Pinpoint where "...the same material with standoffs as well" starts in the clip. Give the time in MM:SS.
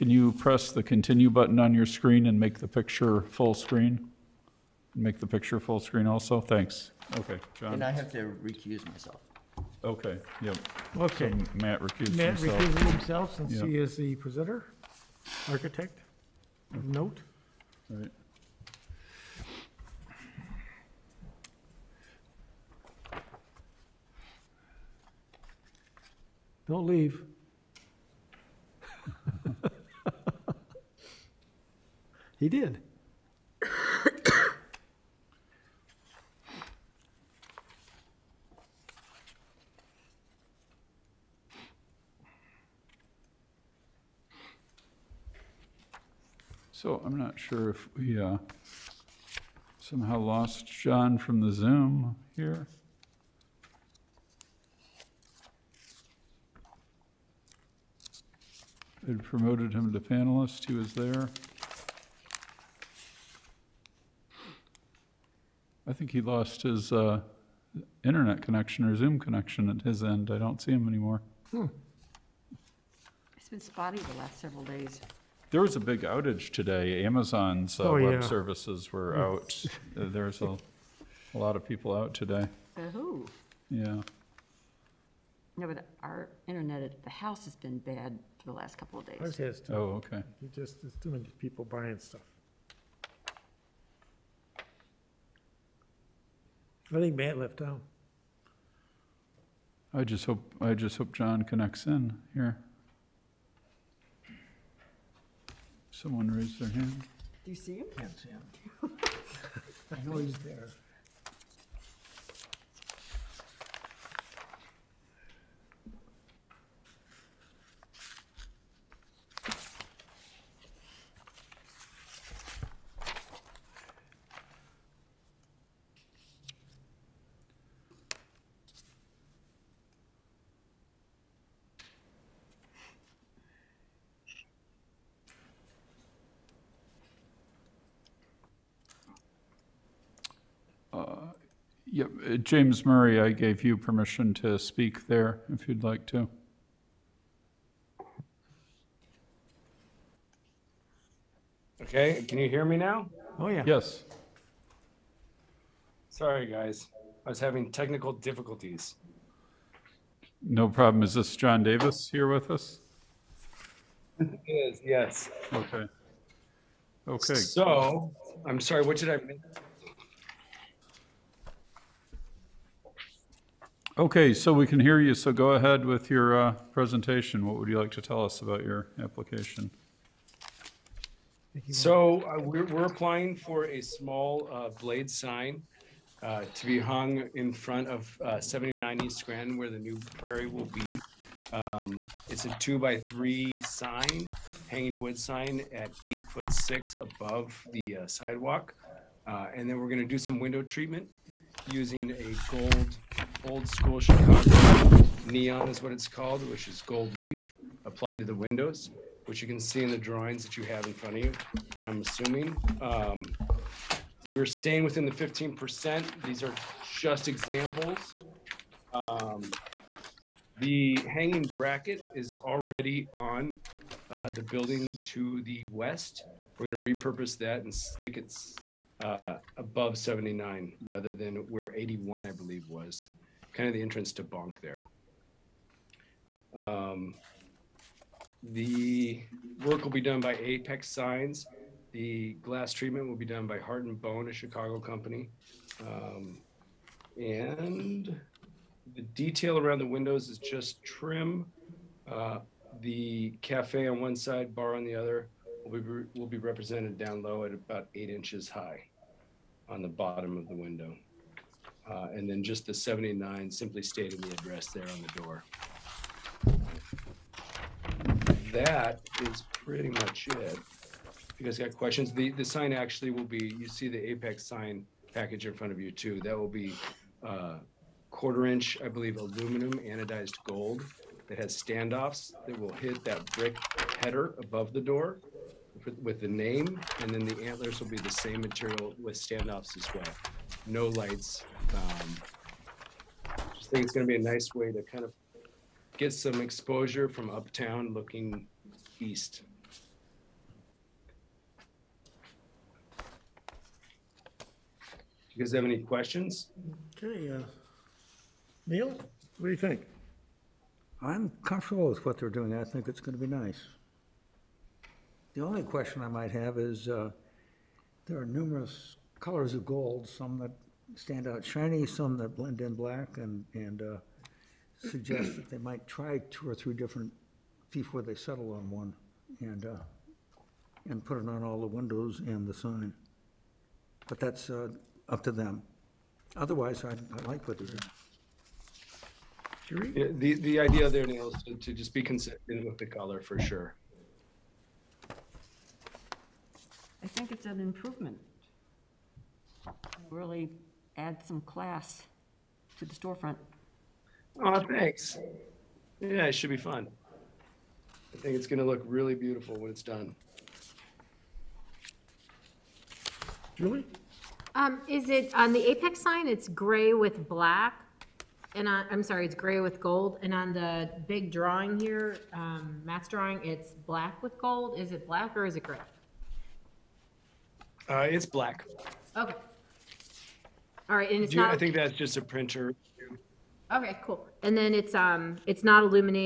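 04:47.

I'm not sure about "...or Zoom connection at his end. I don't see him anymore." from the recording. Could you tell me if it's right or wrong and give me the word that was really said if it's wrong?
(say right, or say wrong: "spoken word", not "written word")
right.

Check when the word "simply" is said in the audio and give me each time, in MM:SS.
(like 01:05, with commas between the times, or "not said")
04:23.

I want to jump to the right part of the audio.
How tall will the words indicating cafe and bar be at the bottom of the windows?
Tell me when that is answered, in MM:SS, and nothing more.
04:17.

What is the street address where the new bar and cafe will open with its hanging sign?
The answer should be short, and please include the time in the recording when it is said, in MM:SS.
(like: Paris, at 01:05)
79 East Grand, at 03:08.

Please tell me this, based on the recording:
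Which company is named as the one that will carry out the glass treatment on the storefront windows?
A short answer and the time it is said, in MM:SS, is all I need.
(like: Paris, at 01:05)
Heart and Bone, at 04:03.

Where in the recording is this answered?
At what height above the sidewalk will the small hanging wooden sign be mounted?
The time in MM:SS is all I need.
03:16.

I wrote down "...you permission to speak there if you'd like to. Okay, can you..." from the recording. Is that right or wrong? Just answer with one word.
right.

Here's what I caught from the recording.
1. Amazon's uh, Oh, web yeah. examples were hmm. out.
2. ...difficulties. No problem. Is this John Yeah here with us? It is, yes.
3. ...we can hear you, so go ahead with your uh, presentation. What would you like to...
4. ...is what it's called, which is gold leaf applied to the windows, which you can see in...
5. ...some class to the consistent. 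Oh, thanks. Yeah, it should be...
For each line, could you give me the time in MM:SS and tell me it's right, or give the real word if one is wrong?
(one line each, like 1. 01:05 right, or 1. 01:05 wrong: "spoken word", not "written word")
1. 01:17 wrong: "services", not "examples"
2. 02:38 wrong: "Davis", not "Yeah"
3. 02:54 right
4. 03:25 right
5. 05:51 wrong: "storefront", not "consistent".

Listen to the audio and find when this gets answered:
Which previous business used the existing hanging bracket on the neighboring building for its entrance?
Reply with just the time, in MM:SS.
03:54.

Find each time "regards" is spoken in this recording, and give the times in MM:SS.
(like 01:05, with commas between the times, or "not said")
not said.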